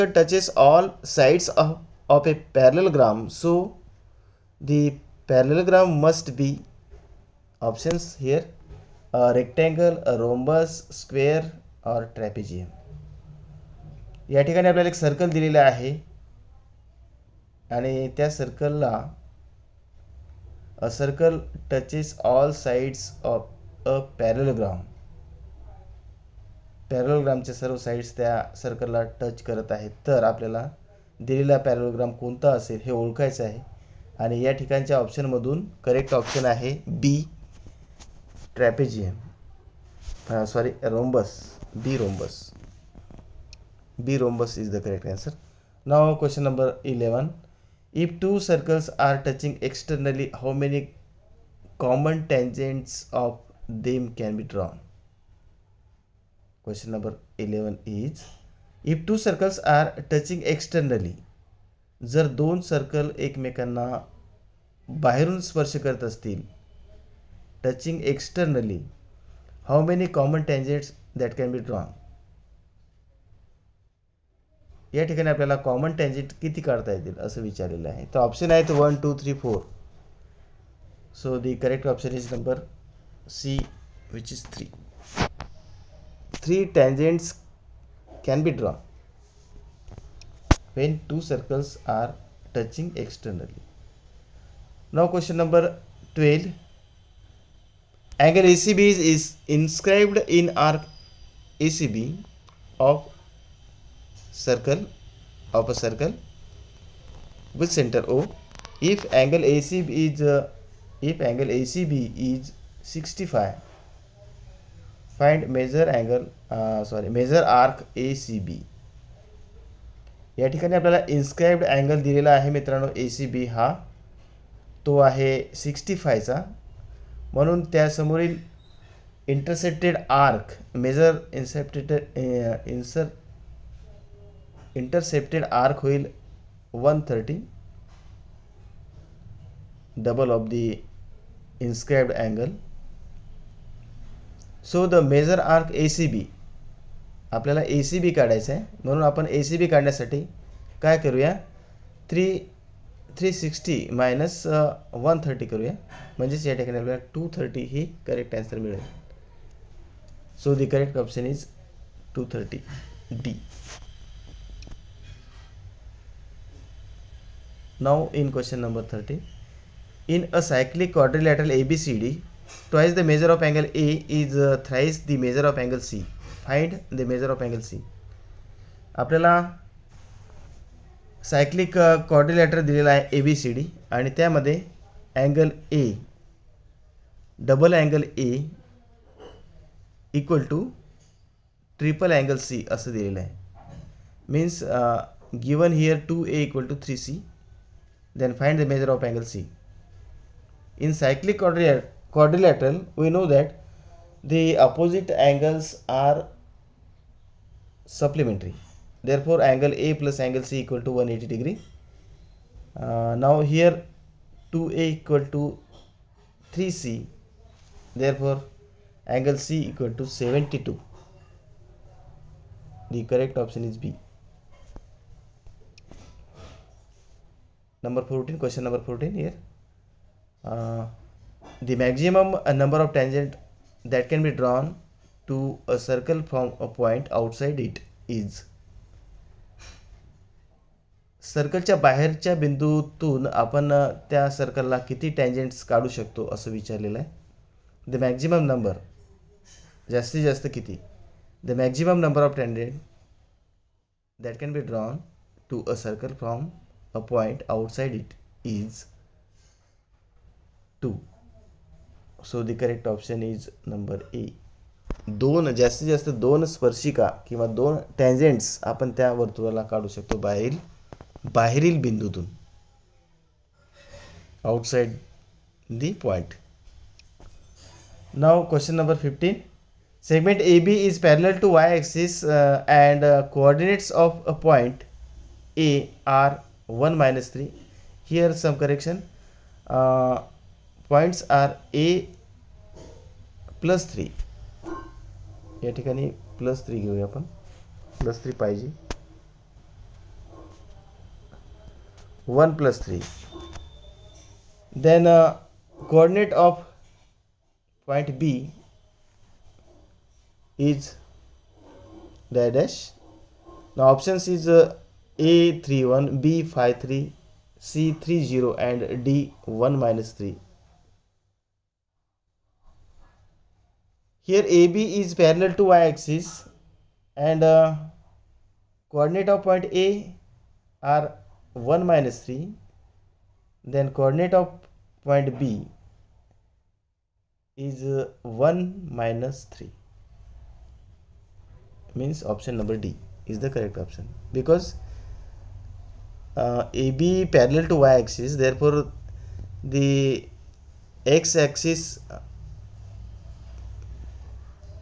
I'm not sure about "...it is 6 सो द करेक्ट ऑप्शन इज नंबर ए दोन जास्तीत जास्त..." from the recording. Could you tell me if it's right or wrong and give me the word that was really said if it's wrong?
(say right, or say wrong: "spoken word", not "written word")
wrong: "2", not "6".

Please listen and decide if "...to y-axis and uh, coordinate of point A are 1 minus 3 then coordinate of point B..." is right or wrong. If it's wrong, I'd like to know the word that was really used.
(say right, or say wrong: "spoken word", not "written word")
right.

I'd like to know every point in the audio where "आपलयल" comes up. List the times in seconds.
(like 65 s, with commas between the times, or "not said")
14 s, 30 s, 120 s, 147 s, 156 s, 178 s.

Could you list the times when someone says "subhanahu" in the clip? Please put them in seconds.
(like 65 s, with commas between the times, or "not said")
not said.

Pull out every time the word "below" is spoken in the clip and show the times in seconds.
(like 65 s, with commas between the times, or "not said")
not said.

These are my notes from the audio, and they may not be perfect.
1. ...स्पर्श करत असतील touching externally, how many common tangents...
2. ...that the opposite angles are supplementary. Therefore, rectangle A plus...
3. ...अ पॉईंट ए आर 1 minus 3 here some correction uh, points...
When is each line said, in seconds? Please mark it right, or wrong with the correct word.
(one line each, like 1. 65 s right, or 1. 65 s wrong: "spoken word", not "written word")
1. 65 s right
2. 203 s wrong: "angle", not "rectangle"
3. 284 s right.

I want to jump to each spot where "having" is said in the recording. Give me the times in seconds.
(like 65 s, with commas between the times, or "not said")
not said.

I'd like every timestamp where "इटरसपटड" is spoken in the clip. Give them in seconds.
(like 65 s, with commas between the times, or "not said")
129 s, 134 s.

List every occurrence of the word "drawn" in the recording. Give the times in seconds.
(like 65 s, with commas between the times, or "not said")
54 s, 71 s.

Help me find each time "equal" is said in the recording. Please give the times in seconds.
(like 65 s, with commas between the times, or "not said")
210 s, 214 s, 219 s.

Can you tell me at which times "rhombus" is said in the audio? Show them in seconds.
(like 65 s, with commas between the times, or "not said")
10 s, 44 s.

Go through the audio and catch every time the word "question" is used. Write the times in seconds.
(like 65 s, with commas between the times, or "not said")
46 s, 56 s, 168 s.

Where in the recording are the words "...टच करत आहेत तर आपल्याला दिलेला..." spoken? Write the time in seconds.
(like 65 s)
29 s.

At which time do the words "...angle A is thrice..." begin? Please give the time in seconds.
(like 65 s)
173 s.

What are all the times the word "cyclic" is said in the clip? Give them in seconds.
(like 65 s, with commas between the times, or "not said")
170 s, 200 s.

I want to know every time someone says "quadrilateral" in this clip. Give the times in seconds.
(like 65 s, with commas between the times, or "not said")
170 s, 201 s.